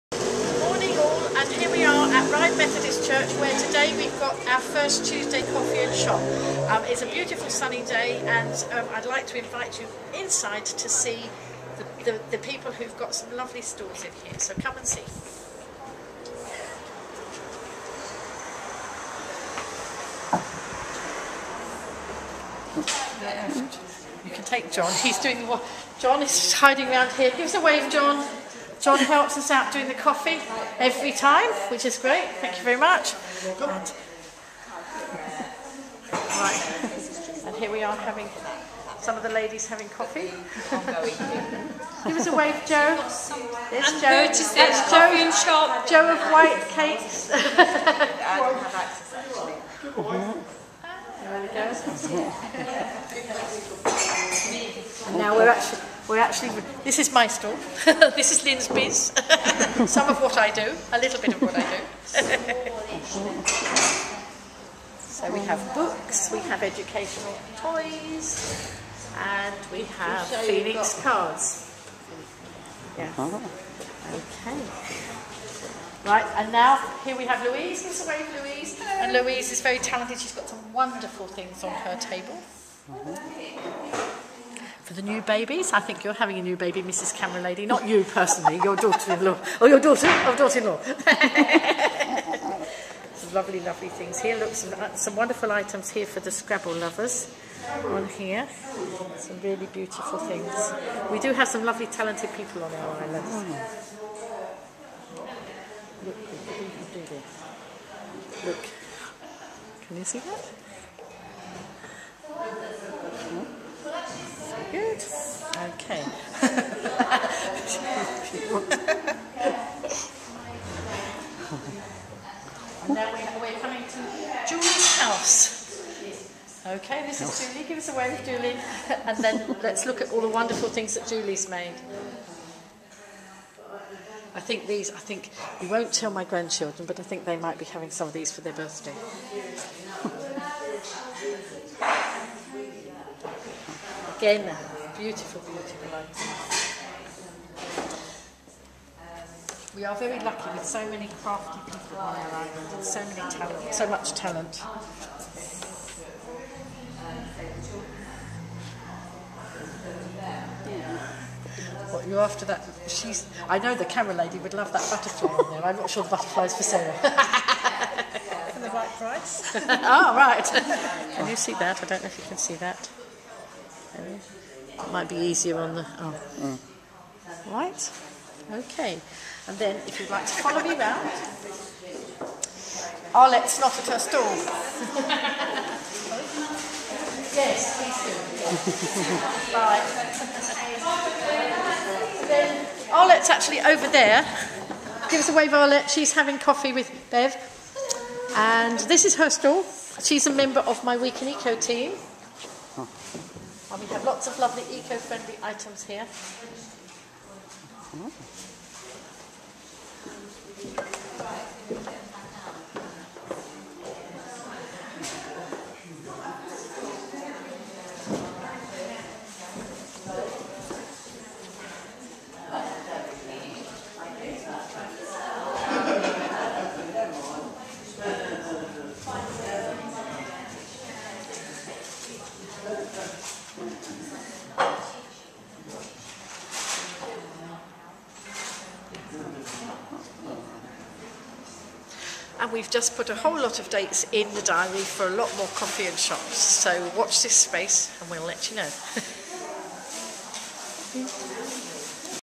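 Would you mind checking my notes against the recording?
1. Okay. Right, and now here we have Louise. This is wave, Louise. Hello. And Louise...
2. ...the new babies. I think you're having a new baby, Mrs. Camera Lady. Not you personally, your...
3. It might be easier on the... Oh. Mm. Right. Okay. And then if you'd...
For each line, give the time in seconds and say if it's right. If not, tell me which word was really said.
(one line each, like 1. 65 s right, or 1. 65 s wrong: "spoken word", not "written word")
1. 74 s right
2. 85 s right
3. 174 s right.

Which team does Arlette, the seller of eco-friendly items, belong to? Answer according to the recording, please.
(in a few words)
Week in Eco.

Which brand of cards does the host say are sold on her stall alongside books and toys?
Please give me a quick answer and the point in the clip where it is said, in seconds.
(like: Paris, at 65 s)
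Phoenix cards, at 70 s.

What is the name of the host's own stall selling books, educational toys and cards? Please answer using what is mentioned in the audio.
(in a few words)
Lyn's Biz.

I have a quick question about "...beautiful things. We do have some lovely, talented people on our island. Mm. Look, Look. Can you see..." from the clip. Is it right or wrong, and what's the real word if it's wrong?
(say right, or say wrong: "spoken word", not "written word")
right.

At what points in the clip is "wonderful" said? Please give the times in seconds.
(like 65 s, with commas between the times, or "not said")
80 s, 95 s, 130 s.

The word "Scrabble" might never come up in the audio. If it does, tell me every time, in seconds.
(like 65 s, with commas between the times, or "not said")
96 s.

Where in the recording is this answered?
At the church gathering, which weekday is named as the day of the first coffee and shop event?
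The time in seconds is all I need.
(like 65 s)
5 s.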